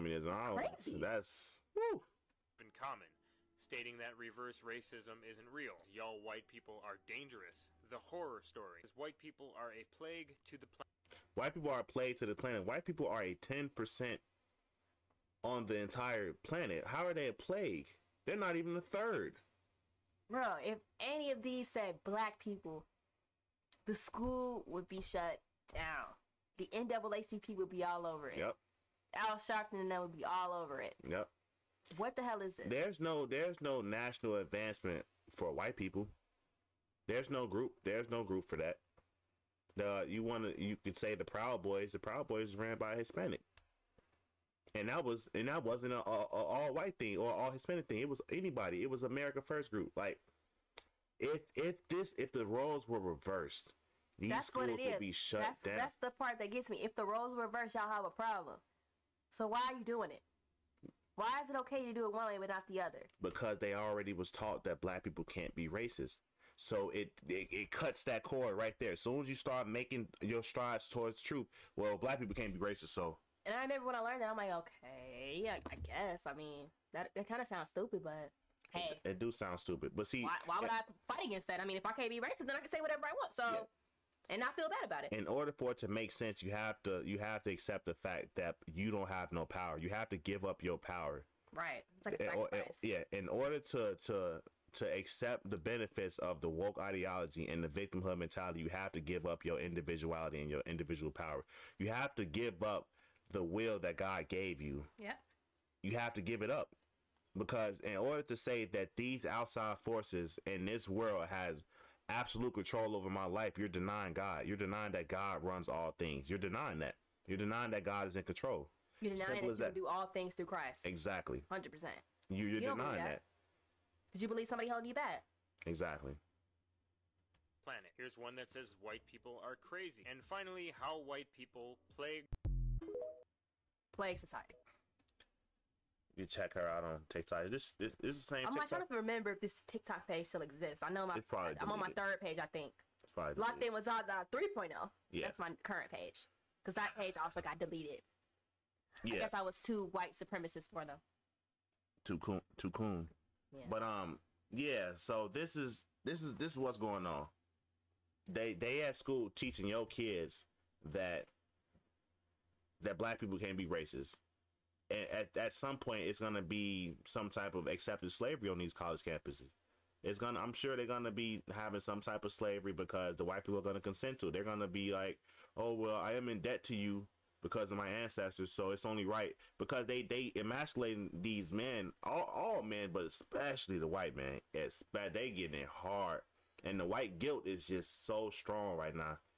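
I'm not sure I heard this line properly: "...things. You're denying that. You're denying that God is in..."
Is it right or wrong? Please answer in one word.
right.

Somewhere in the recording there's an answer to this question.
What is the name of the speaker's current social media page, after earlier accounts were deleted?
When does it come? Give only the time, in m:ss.
2:23.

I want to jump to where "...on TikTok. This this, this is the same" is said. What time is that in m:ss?
2:16.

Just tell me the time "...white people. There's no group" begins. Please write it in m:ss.
0:35.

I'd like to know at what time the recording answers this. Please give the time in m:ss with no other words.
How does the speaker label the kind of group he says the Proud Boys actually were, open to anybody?
0:49.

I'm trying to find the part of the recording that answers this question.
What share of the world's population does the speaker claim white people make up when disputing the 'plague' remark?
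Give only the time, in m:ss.
0:13.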